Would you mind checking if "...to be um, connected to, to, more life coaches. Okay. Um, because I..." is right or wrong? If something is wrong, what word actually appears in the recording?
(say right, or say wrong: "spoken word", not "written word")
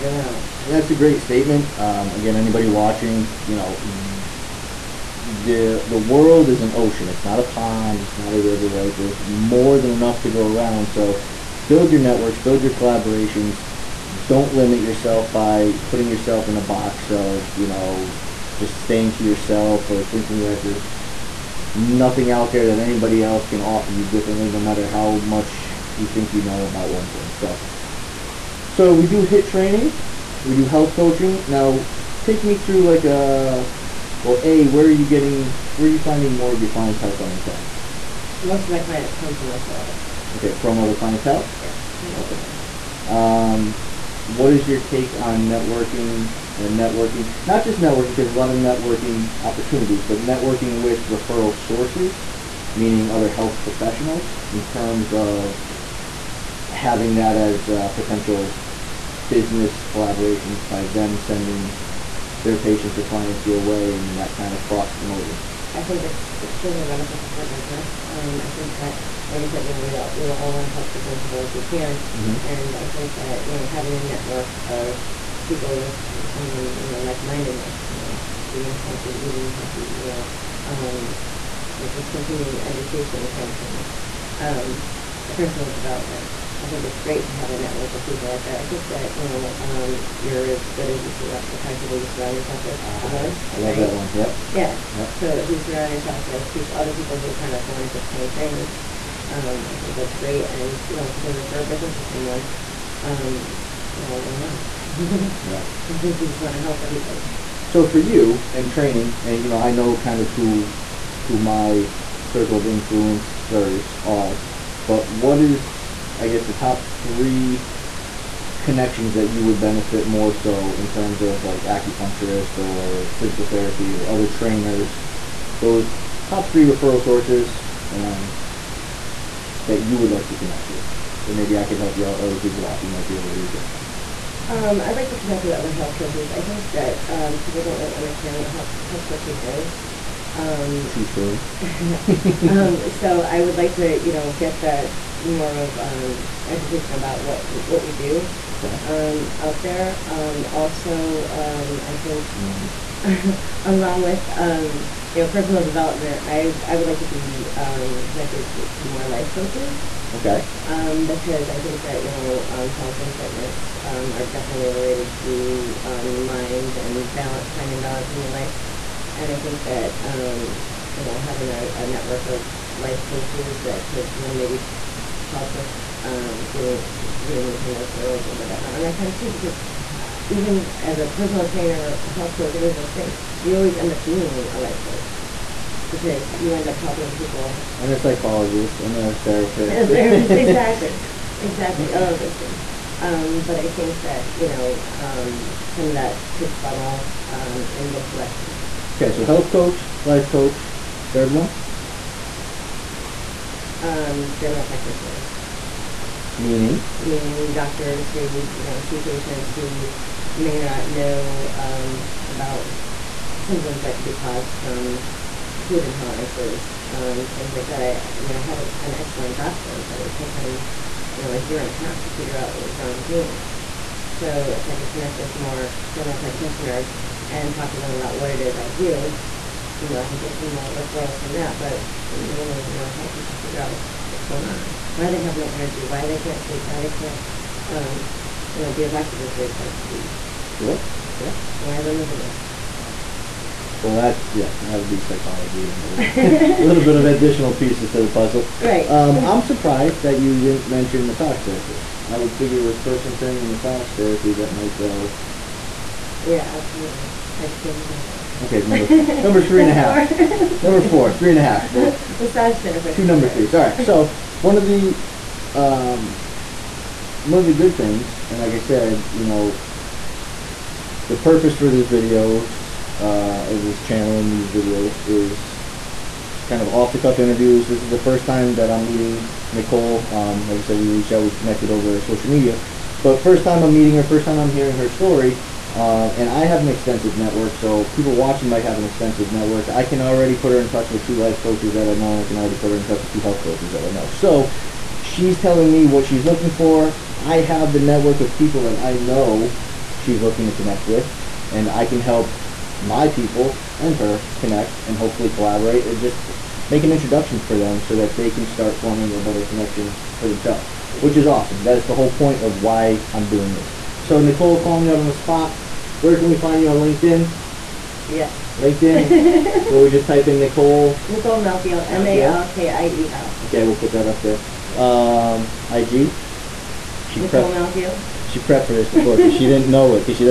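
right.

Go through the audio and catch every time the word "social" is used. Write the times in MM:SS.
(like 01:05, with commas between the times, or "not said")
04:41.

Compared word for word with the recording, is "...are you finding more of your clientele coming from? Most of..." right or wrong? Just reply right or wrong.
right.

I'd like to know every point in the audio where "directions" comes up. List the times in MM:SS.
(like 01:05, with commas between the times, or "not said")
03:18.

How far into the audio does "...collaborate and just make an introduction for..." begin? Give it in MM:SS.
05:05.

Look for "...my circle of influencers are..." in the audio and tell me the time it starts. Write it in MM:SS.
01:51.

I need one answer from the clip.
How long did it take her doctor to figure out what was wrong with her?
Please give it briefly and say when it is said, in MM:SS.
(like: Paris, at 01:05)
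A year and a half, at 03:41.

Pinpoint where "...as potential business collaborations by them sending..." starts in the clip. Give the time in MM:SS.
00:57.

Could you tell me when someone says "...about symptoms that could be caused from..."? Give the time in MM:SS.
03:32.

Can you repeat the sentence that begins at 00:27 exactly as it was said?
So, so we do HIIT training, we do health coaching.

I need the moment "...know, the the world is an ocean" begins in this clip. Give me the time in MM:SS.
00:03.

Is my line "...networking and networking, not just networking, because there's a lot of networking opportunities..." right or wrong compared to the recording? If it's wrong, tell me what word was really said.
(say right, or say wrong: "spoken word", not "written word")
right.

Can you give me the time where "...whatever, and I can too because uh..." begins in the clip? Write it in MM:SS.
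02:58.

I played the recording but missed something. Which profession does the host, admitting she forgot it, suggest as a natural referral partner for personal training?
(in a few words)
Massage therapists.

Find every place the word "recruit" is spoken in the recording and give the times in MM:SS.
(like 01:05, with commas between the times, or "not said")
not said.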